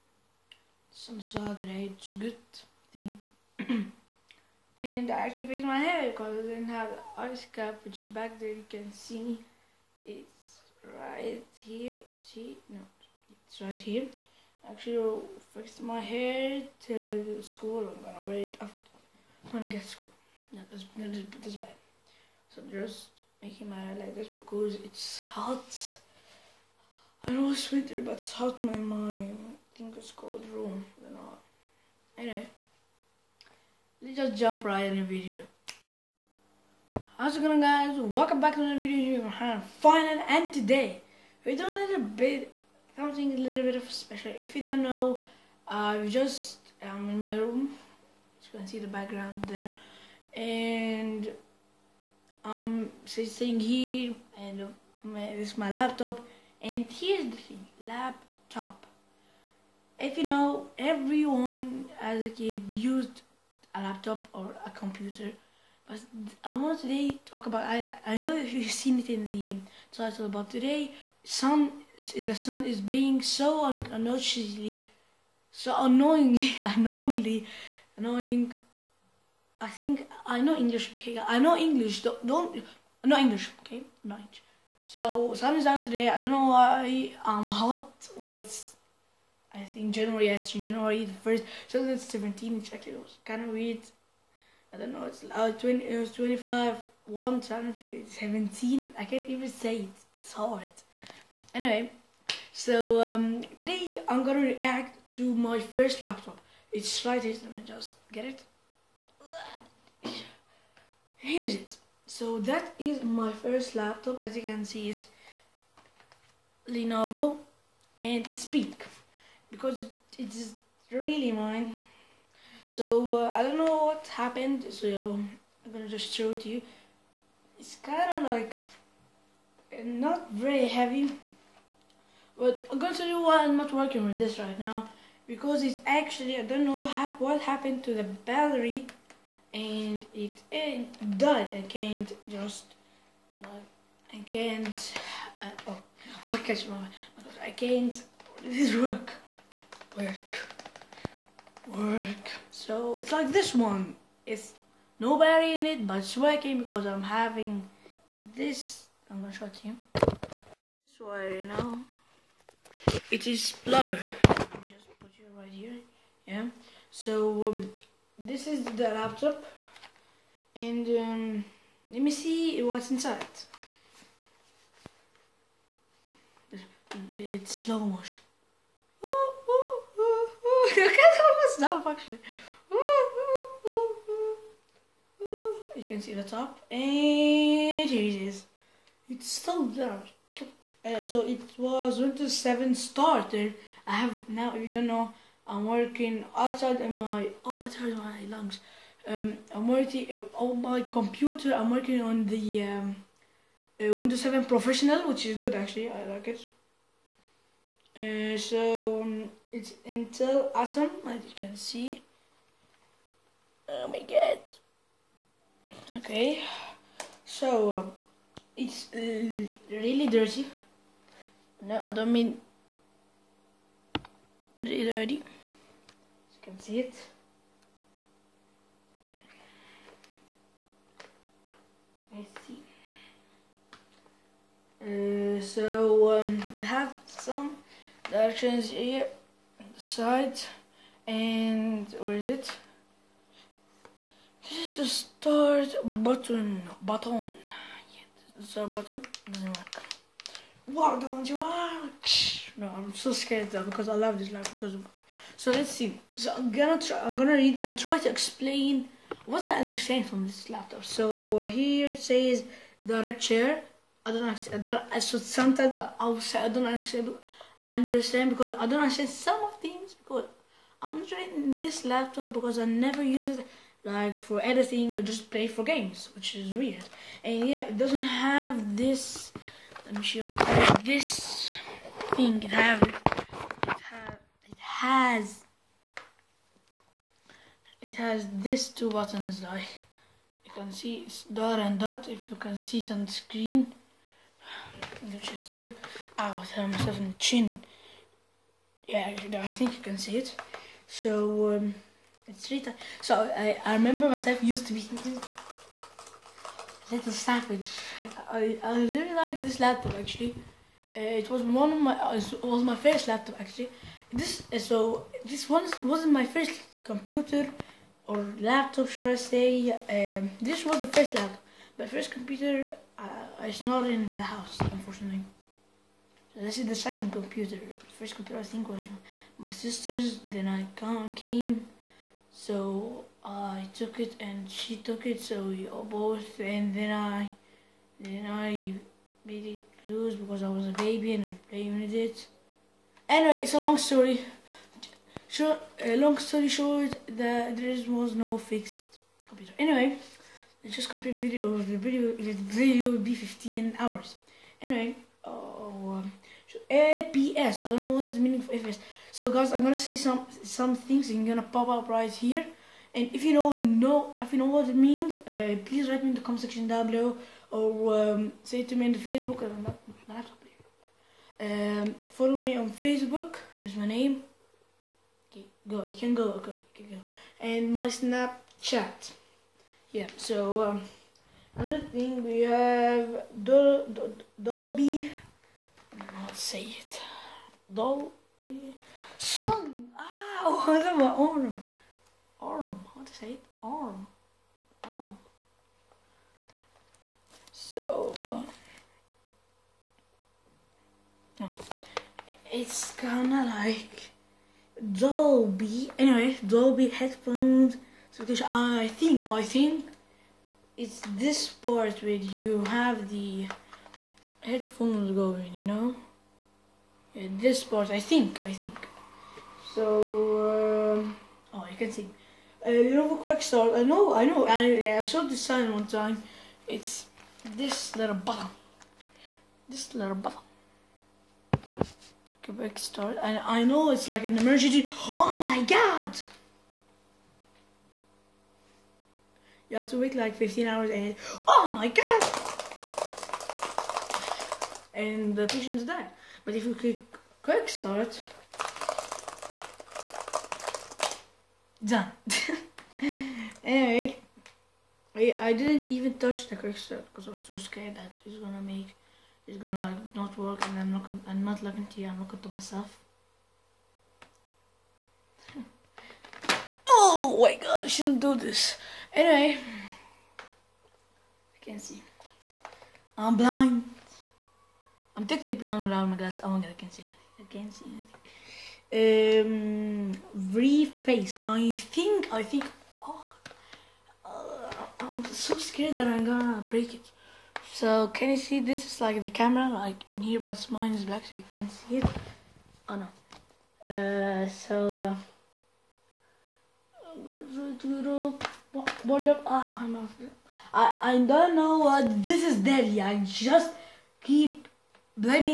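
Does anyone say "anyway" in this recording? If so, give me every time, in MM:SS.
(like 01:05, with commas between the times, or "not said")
00:32, 01:41, 05:43, 05:49, 05:54, 06:45, 07:33, 07:49.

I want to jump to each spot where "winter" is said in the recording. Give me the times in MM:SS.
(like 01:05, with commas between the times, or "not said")
00:27.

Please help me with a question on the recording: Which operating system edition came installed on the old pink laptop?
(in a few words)
Windows 7 Starter.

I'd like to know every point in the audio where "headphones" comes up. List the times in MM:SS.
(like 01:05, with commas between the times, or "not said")
06:46, 06:54.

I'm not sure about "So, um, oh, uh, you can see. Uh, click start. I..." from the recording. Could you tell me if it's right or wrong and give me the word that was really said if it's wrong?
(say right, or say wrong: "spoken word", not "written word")
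wrong: "quick", not "click".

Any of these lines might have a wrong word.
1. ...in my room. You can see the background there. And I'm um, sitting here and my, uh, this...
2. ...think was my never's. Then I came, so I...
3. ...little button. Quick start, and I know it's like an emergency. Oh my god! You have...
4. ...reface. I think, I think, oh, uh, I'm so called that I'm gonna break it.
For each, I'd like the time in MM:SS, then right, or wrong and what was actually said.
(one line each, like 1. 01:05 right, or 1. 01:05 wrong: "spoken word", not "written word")
1. 00:47 right
2. 05:28 wrong: "sister", not "never"
3. 07:09 right
4. 08:00 wrong: "scared", not "called".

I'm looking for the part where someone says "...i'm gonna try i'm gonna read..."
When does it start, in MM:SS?
04:16.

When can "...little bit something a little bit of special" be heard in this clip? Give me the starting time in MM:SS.
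00:41.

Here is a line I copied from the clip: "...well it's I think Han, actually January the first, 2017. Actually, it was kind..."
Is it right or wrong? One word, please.
wrong.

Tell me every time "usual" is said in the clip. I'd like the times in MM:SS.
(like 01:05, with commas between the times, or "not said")
not said.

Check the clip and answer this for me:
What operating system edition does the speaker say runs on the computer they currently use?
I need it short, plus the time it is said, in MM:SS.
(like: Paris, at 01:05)
Windows 7 Professional, at 03:23.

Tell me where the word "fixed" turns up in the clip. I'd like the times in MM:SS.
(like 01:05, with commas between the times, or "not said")
00:05, 05:48.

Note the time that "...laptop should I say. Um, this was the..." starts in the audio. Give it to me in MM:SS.
05:18.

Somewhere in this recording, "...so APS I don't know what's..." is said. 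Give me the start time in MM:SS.
05:56.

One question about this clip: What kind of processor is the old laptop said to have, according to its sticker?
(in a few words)
Intel Atom.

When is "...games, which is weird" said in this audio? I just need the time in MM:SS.
04:35.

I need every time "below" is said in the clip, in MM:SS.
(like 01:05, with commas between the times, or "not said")
06:06.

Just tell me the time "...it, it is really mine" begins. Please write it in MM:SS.
01:59.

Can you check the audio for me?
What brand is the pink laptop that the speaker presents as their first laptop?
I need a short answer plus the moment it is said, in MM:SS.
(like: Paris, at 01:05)
Lenovo, at 01:56.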